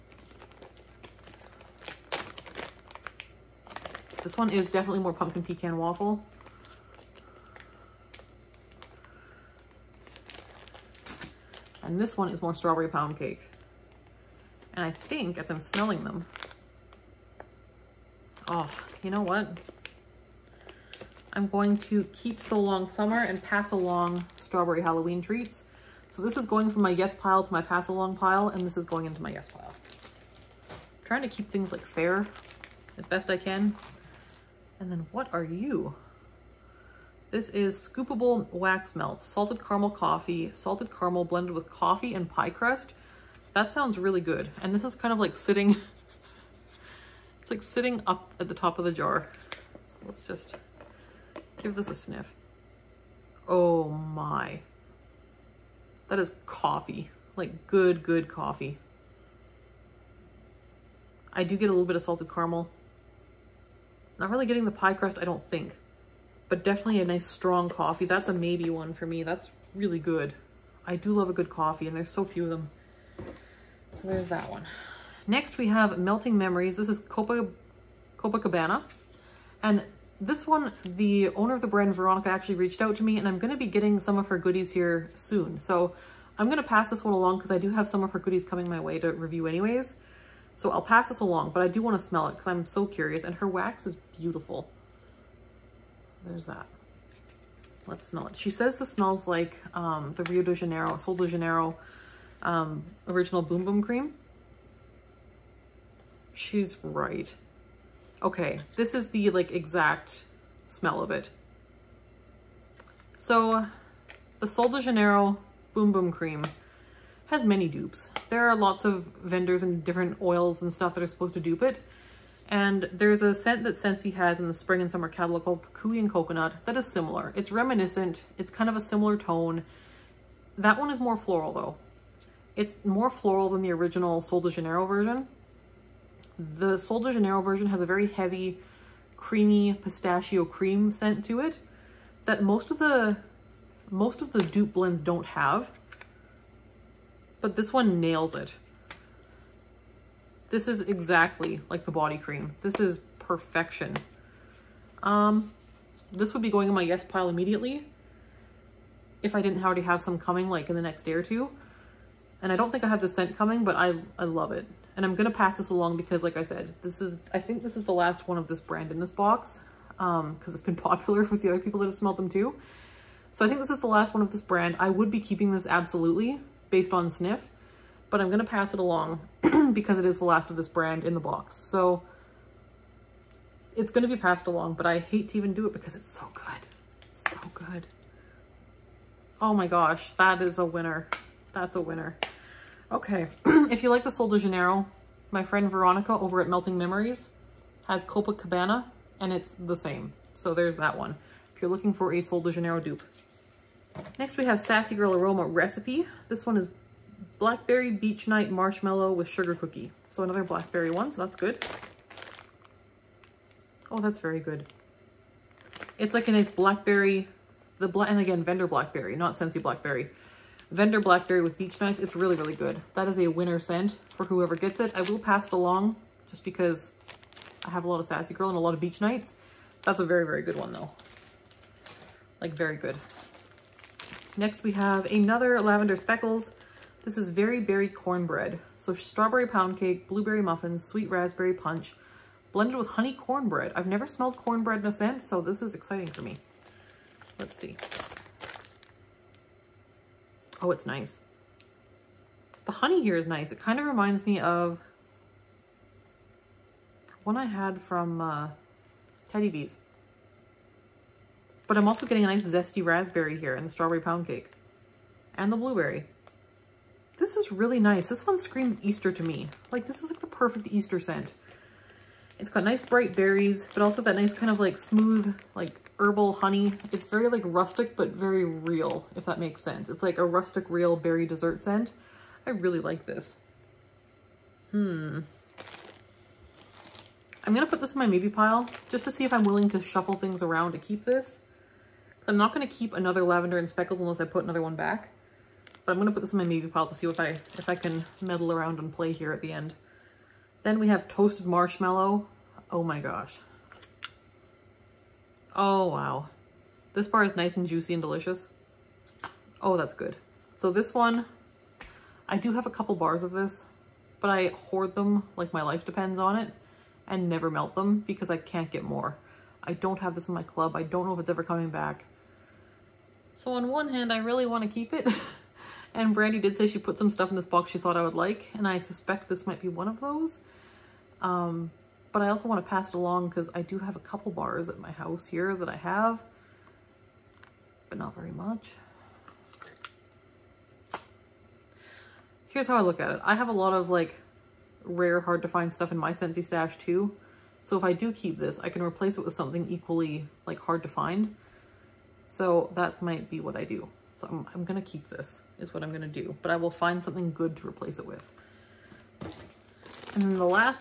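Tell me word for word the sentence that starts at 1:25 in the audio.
So I'm going to pass this one along because I do have some of her goodies coming my way to review anyways.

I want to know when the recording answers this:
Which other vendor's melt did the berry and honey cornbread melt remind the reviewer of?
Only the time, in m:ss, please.
4:19.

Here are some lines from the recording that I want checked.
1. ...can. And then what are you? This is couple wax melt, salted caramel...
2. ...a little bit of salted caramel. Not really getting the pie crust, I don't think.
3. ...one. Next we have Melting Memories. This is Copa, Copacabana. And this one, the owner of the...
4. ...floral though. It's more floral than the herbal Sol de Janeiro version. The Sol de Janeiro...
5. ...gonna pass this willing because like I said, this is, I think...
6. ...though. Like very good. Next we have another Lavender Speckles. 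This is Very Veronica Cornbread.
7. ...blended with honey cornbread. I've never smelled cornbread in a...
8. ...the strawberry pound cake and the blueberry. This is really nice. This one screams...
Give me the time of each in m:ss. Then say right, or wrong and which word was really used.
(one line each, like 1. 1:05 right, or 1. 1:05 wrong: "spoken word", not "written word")
1. 0:33 wrong: "scoopable", not "couple"
2. 1:01 right
3. 1:14 right
4. 2:11 wrong: "original", not "herbal"
5. 2:45 wrong: "along", not "willing"
6. 3:50 wrong: "Berry", not "Veronica"
7. 4:02 right
8. 4:23 right.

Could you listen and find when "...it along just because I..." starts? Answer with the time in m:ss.
3:45.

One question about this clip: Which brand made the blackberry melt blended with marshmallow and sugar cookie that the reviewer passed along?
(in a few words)
Sassy Girl Aroma Recipe.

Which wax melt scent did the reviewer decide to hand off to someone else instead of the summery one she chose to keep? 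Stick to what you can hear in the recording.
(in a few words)
Strawberry Halloween Treats.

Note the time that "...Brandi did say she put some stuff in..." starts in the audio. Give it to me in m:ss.
5:26.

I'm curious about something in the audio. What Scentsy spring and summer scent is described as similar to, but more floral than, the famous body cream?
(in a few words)
Kukui and Coconut.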